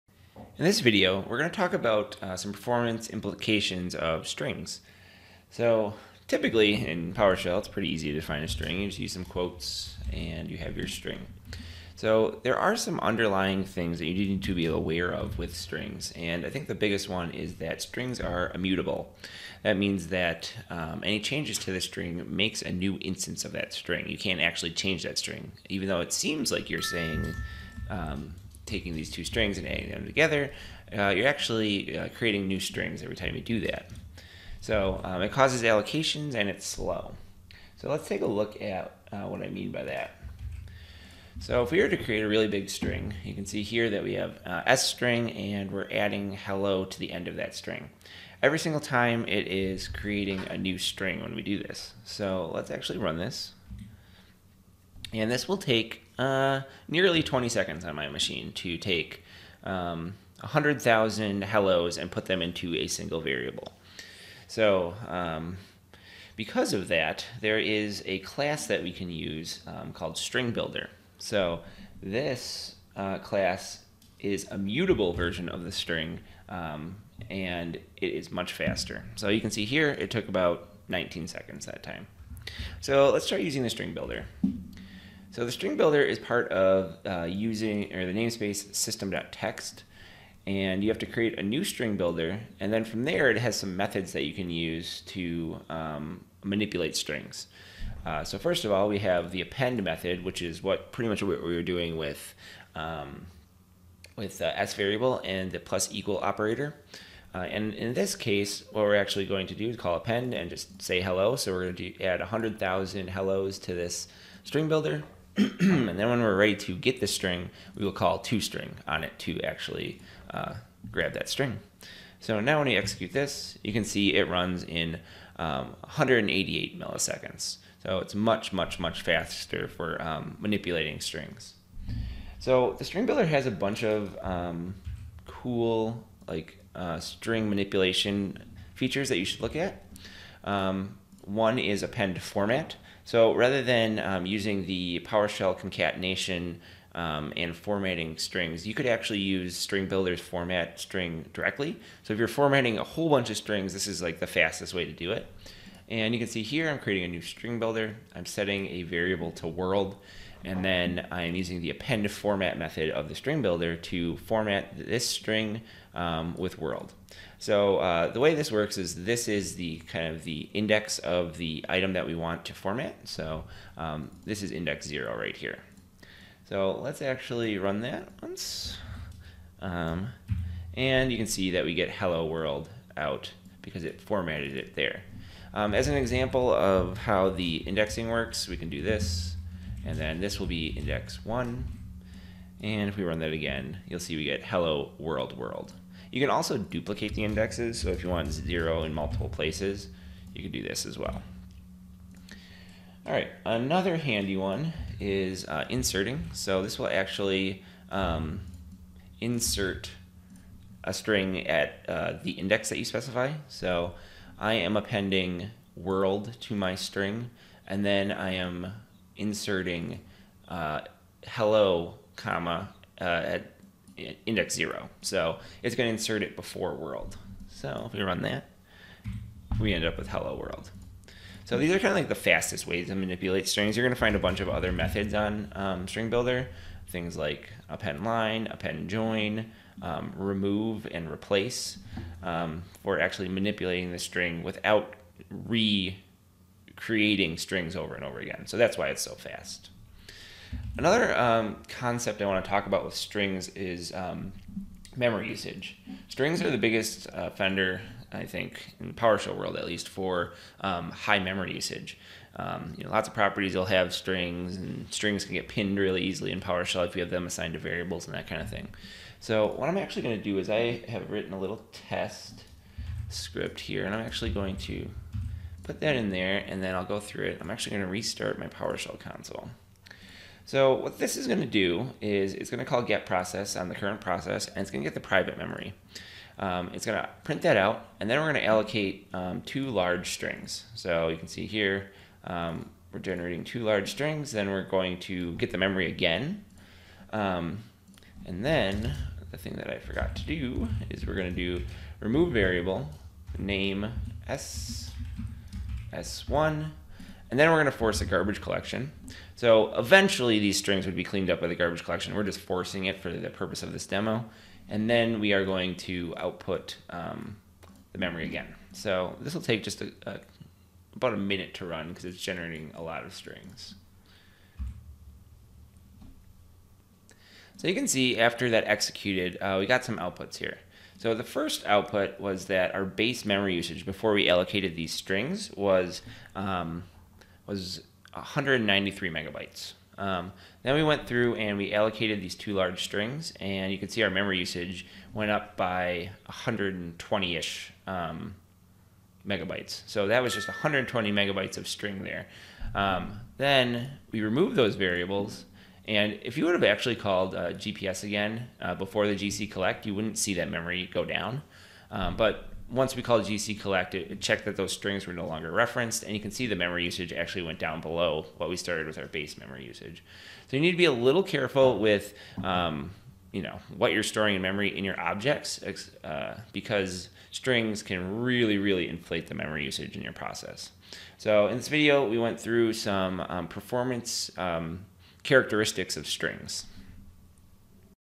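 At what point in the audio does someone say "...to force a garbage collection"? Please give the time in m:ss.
5:07.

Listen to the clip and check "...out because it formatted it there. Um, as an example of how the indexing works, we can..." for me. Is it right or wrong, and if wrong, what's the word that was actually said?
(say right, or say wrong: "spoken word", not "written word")
right.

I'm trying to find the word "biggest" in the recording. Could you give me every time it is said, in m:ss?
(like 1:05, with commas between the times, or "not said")
0:16, 4:16.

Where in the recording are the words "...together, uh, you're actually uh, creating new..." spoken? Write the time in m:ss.
0:30.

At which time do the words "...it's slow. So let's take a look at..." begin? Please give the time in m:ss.
0:36.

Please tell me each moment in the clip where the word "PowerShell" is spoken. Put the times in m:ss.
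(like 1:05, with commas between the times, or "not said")
0:07, 2:25, 4:18, 4:26, 4:38.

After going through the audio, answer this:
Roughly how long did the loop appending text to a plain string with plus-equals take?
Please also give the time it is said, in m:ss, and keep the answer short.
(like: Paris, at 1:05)
19 seconds, at 1:20.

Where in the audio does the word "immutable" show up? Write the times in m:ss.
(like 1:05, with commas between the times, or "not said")
0:18.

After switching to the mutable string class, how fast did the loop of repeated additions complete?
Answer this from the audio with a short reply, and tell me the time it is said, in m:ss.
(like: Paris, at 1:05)
188 milliseconds, at 2:05.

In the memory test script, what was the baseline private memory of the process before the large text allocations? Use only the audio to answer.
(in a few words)
193 megabytes.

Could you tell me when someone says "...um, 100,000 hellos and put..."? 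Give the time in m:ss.
0:59.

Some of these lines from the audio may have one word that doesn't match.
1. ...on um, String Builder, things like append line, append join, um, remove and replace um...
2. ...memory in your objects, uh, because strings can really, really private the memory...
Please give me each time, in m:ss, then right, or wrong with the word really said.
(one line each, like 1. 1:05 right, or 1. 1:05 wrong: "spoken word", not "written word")
1. 3:55 right
2. 6:14 wrong: "inflate", not "private".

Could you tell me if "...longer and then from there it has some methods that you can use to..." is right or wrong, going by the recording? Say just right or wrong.
wrong.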